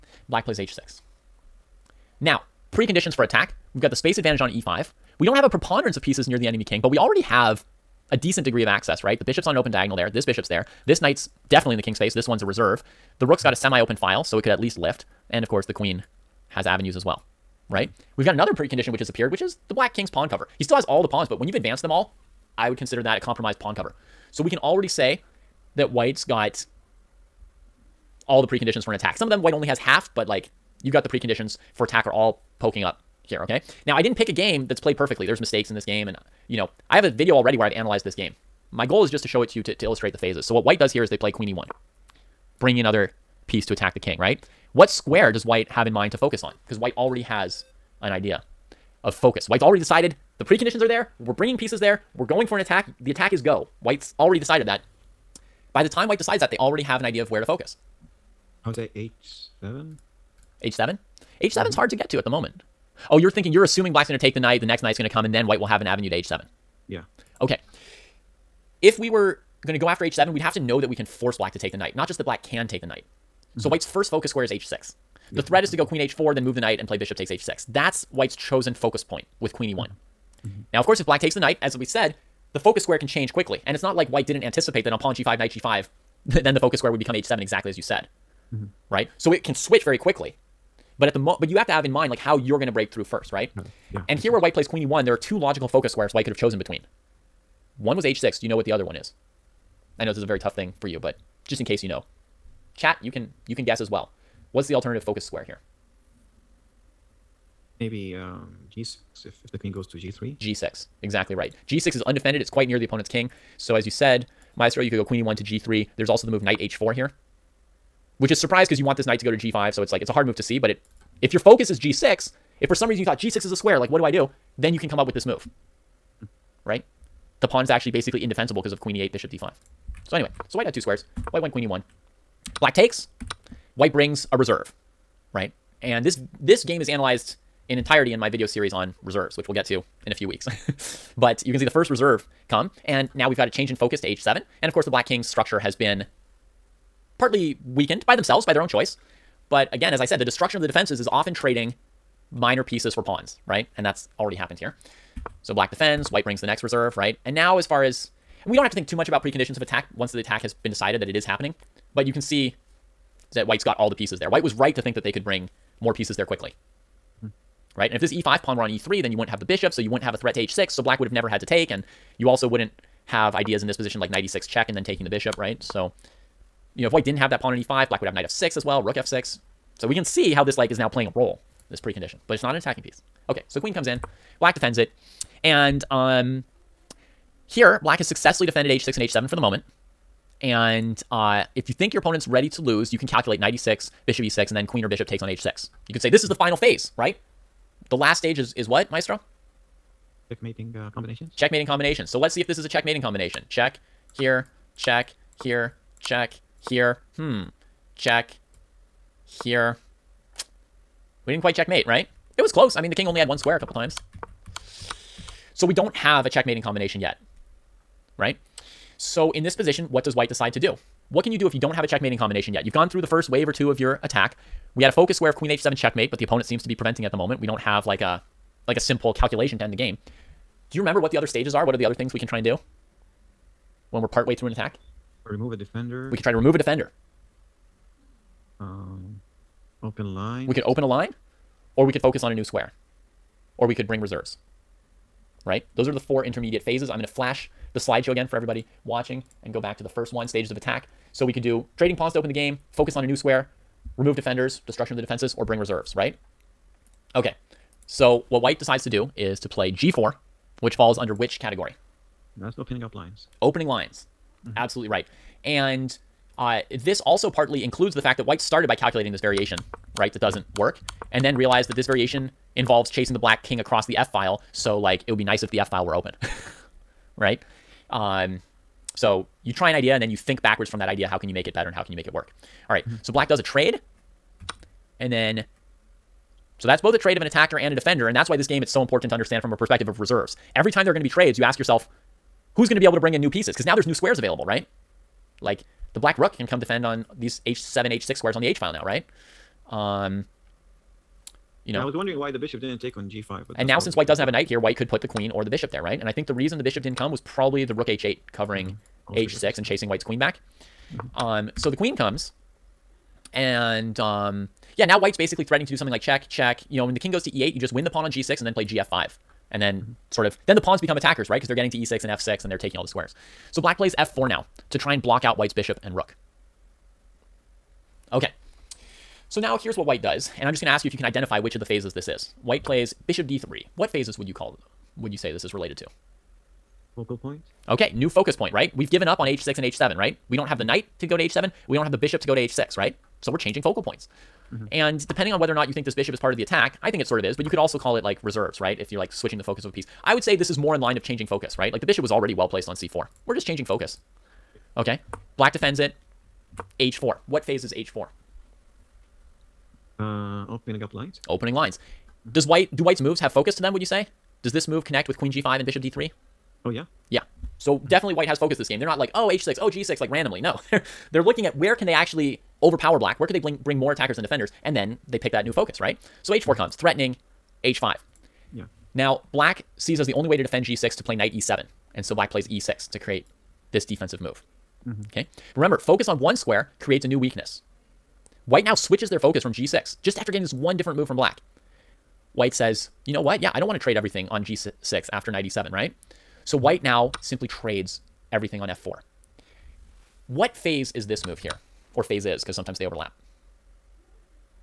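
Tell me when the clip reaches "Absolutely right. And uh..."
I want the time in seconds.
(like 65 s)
264 s.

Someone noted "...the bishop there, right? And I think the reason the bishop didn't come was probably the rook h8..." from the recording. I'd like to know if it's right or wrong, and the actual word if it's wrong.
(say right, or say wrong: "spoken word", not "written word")
right.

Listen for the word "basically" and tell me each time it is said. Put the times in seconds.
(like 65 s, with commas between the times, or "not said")
127 s, 315 s.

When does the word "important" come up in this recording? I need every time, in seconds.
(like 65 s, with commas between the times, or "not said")
288 s.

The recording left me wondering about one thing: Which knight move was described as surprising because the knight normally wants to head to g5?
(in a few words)
Knight h4.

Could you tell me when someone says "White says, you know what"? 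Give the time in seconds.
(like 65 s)
392 s.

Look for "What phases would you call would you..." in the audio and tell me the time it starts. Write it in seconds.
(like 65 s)
333 s.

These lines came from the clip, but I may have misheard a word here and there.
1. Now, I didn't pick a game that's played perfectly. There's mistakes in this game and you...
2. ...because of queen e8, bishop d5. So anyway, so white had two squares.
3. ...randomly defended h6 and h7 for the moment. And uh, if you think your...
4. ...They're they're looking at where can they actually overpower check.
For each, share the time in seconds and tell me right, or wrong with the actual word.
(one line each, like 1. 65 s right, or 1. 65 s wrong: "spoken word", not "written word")
1. 33 s right
2. 128 s right
3. 188 s wrong: "successfully", not "randomly"
4. 370 s wrong: "black", not "check".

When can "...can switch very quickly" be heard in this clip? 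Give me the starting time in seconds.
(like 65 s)
89 s.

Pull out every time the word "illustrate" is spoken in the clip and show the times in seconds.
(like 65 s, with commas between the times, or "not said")
39 s.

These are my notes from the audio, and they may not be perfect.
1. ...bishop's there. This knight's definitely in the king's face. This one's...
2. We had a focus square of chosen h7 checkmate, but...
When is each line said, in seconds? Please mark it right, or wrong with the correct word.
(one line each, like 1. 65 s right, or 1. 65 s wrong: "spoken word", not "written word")
1. 10 s right
2. 224 s wrong: "queen", not "chosen".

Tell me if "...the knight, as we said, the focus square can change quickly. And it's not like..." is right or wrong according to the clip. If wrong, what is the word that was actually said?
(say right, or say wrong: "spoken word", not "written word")
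right.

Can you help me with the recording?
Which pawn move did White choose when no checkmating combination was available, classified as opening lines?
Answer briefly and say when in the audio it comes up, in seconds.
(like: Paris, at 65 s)
g4, at 259 s.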